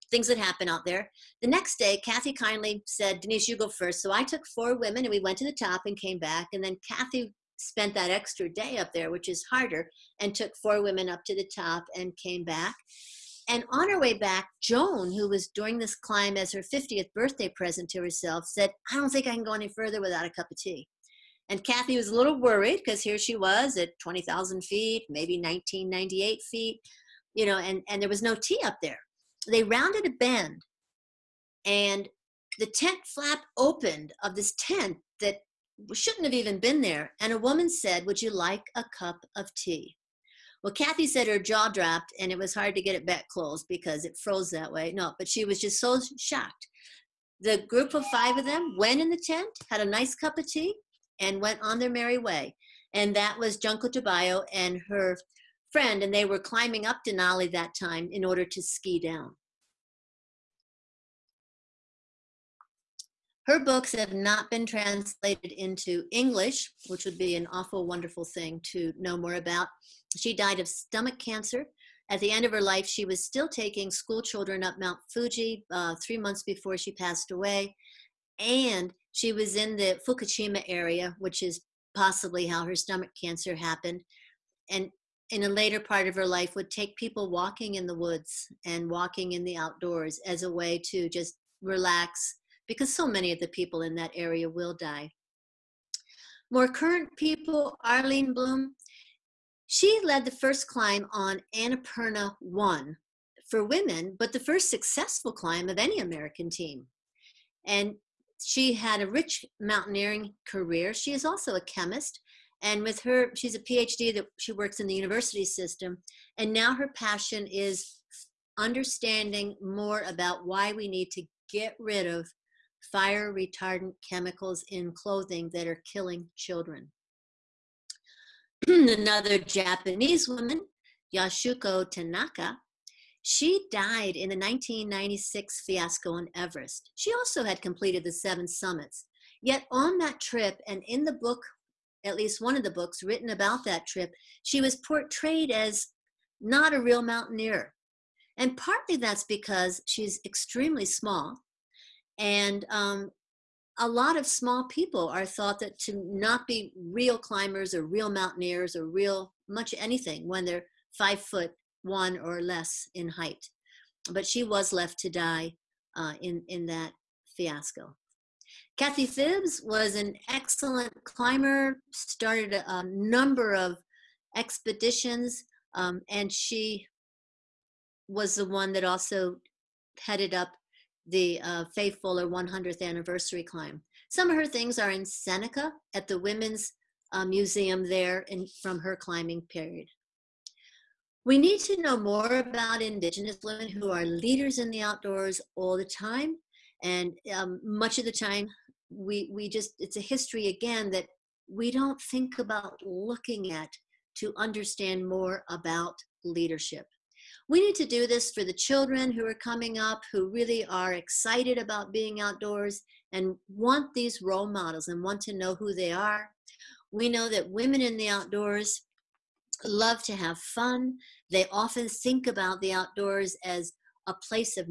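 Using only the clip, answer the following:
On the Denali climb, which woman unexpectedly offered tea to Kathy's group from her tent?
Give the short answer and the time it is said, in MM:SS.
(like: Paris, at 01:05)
Junko Tabei, at 00:53.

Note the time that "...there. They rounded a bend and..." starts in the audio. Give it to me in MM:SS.
00:28.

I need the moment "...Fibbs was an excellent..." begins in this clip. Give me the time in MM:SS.
02:49.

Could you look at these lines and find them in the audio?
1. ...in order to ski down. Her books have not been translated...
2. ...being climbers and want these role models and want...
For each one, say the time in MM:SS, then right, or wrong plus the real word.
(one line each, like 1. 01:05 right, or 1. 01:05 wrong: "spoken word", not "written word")
1. 00:58 right
2. 03:31 wrong: "outdoors", not "climbers".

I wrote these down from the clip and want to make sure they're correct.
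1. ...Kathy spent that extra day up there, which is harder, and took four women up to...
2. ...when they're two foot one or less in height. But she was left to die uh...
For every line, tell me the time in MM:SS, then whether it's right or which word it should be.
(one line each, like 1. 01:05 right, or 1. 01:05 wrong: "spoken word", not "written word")
1. 00:06 right
2. 02:40 wrong: "five", not "two".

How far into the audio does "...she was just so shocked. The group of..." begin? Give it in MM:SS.
00:45.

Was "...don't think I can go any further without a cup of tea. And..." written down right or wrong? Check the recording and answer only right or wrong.
right.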